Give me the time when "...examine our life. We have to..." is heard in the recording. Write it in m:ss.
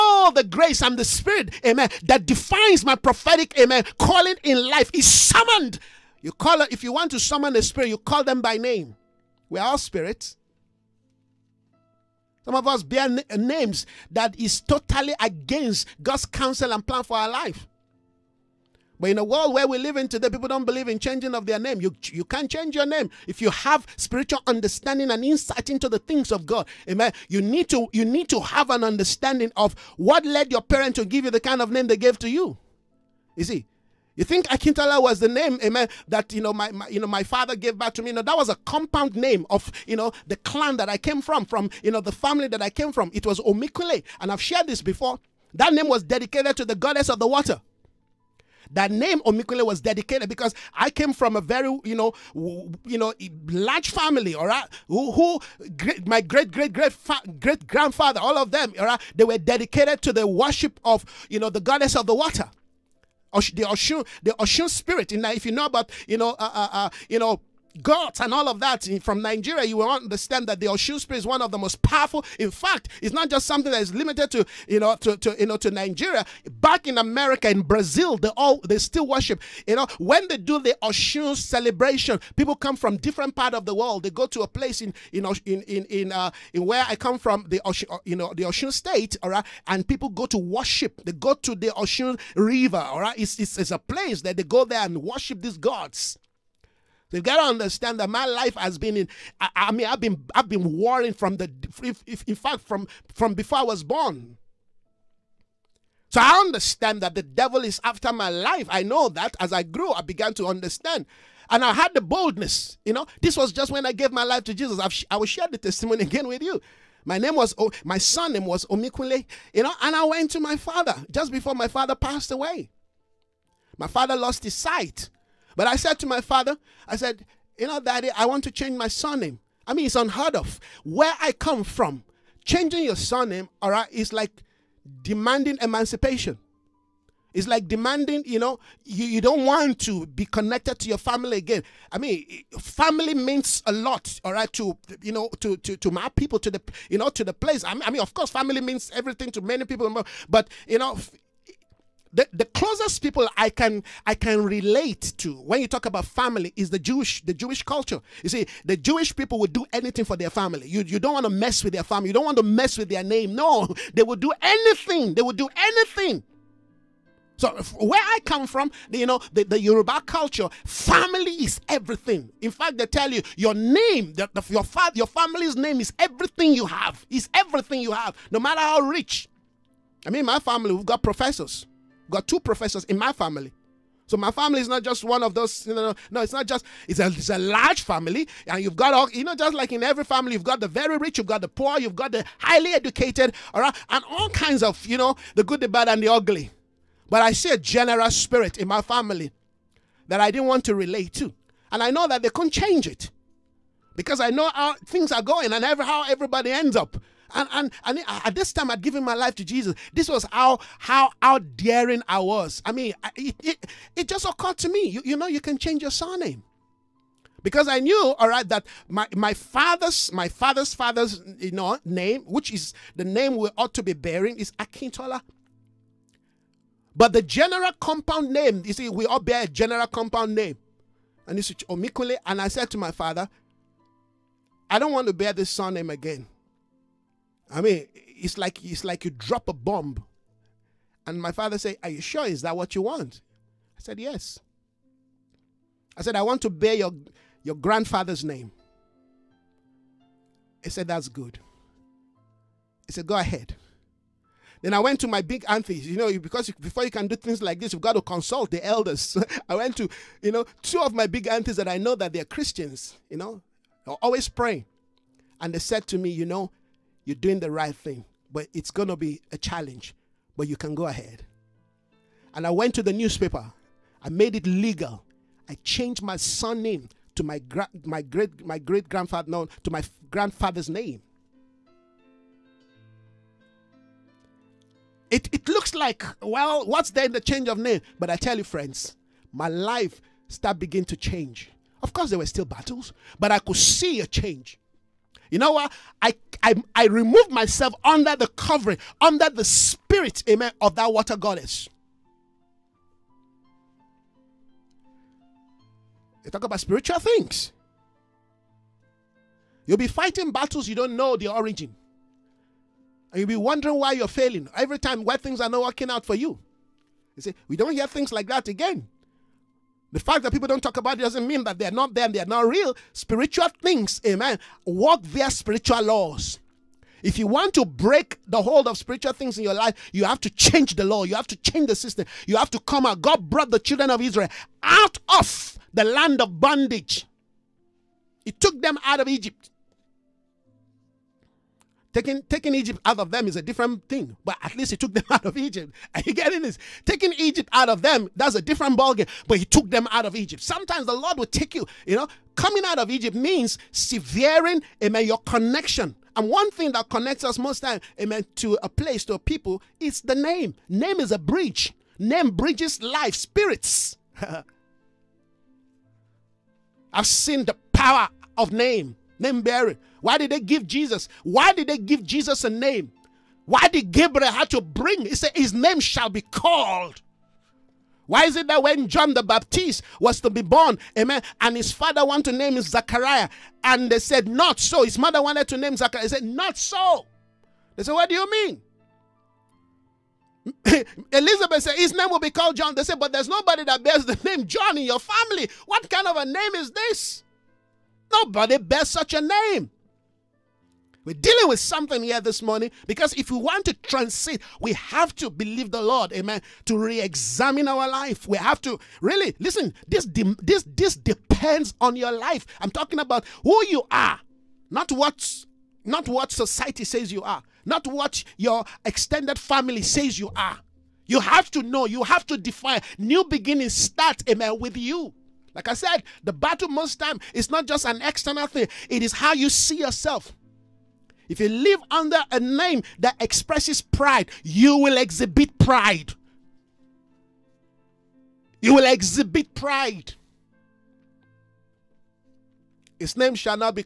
6:46.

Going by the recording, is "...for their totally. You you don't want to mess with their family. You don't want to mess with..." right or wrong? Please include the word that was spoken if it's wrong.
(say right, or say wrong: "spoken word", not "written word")
wrong: "family", not "totally".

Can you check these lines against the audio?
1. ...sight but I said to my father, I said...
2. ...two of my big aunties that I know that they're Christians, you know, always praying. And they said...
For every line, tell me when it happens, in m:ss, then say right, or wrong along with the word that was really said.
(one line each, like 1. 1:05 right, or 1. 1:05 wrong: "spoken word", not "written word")
1. 2:04 right
2. 4:20 right.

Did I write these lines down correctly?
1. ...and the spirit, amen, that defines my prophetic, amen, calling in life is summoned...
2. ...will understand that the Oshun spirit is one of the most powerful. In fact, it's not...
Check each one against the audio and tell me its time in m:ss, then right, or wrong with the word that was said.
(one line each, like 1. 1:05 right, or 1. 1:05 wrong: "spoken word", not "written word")
1. 0:00 right
2. 1:09 right.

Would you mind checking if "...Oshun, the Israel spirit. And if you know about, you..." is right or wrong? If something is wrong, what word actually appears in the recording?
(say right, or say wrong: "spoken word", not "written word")
wrong: "Oshun", not "Israel".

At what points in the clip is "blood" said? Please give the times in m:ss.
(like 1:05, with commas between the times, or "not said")
not said.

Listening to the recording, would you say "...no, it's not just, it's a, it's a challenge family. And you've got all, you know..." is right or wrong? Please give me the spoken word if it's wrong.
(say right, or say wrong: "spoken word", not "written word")
wrong: "large", not "challenge".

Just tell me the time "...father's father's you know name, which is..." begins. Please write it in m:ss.
3:40.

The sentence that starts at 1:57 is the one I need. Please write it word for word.
My name was, oh, my son name was Omikule, you know.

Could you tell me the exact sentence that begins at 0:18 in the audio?
But in a world where we live in today, people don't believe in changing of their name.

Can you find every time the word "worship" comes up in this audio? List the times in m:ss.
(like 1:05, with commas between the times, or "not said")
1:00, 1:19, 1:30, 1:35.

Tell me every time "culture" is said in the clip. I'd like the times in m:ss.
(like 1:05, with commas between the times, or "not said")
2:37, 2:50.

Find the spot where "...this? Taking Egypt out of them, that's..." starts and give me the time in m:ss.
5:46.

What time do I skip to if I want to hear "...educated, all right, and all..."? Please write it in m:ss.
3:12.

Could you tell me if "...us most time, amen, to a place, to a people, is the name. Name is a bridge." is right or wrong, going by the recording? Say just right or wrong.
right.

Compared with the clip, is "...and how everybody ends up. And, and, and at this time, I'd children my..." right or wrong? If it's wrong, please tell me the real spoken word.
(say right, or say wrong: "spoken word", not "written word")
wrong: "given", not "children".